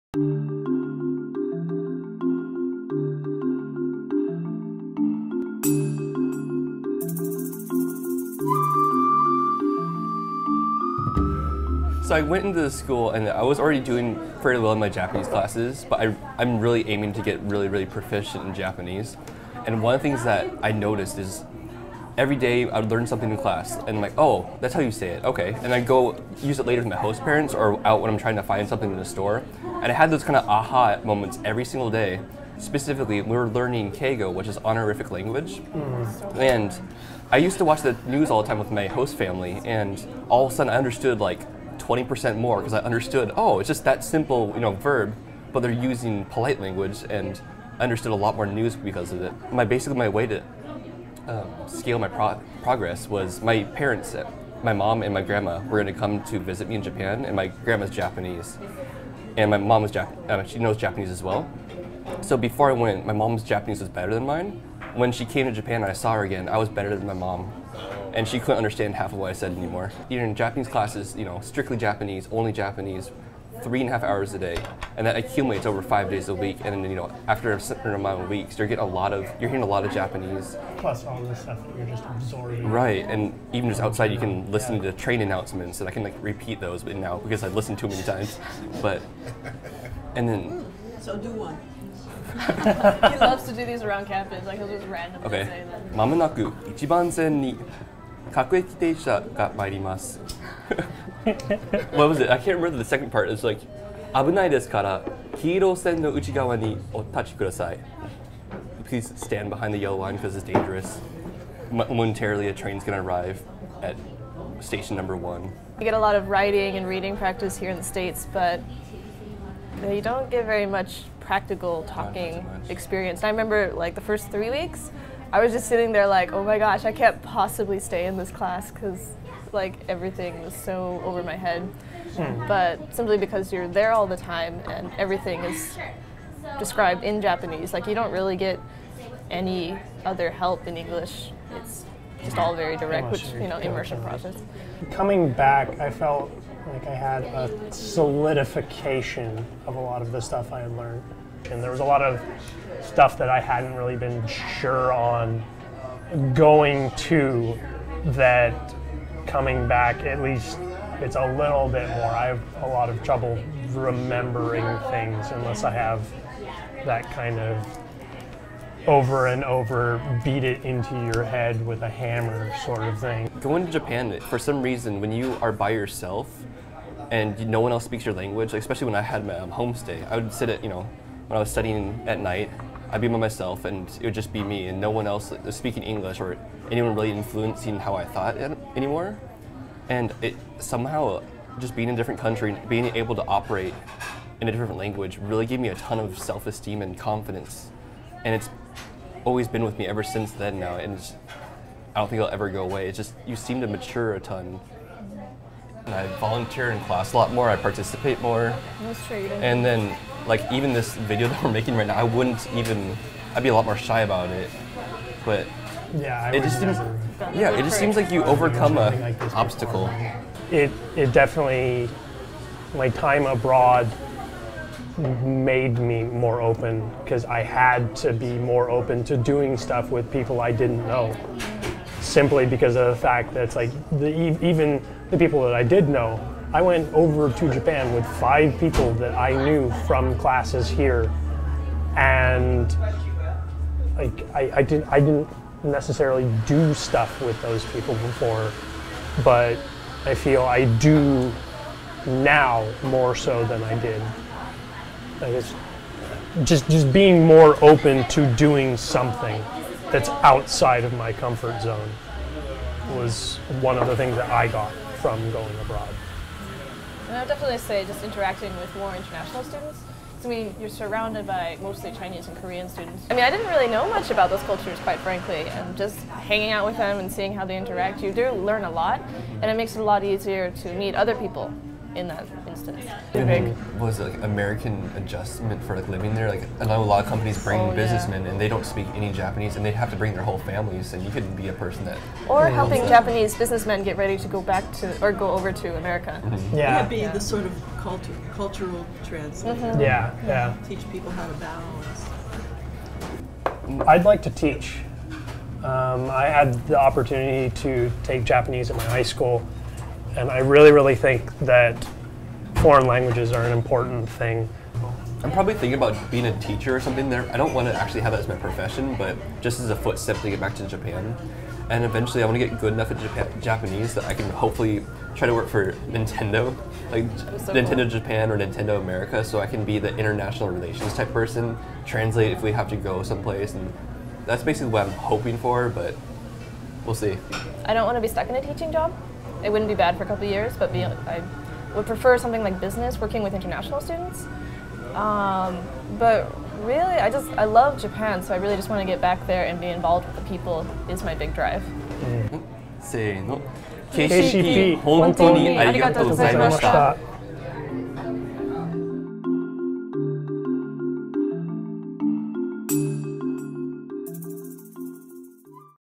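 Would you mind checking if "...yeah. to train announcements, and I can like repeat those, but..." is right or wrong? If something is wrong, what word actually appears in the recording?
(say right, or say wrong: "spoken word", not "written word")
right.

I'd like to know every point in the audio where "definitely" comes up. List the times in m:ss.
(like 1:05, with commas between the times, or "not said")
3:41, 4:27.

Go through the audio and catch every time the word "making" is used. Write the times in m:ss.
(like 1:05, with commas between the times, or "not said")
3:31.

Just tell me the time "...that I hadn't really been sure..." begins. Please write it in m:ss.
2:33.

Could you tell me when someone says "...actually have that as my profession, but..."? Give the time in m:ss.
5:17.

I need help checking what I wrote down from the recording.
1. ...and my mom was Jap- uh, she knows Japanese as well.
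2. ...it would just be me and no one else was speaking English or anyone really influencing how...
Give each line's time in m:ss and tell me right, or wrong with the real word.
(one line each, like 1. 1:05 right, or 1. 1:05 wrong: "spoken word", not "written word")
1. 0:59 right
2. 3:04 right.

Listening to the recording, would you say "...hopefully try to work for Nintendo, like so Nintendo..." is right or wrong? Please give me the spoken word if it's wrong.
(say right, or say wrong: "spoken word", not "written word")
right.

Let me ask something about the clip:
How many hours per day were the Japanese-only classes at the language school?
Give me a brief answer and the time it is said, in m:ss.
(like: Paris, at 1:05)
3.5 hours, at 1:13.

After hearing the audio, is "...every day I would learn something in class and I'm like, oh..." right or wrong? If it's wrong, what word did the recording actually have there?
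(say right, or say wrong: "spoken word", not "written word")
right.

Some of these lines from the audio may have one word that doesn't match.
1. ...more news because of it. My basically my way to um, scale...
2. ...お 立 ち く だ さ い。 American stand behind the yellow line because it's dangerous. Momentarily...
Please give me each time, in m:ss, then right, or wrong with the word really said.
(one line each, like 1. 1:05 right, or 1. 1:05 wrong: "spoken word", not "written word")
1. 0:48 right
2. 1:46 wrong: "Please", not "American".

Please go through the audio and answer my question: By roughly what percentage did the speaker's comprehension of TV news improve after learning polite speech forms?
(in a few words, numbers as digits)
20%.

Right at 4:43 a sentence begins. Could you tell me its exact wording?
was like American adjustment for like living there.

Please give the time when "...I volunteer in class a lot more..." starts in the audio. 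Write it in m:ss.
3:25.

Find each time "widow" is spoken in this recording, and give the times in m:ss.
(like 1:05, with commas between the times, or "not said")
not said.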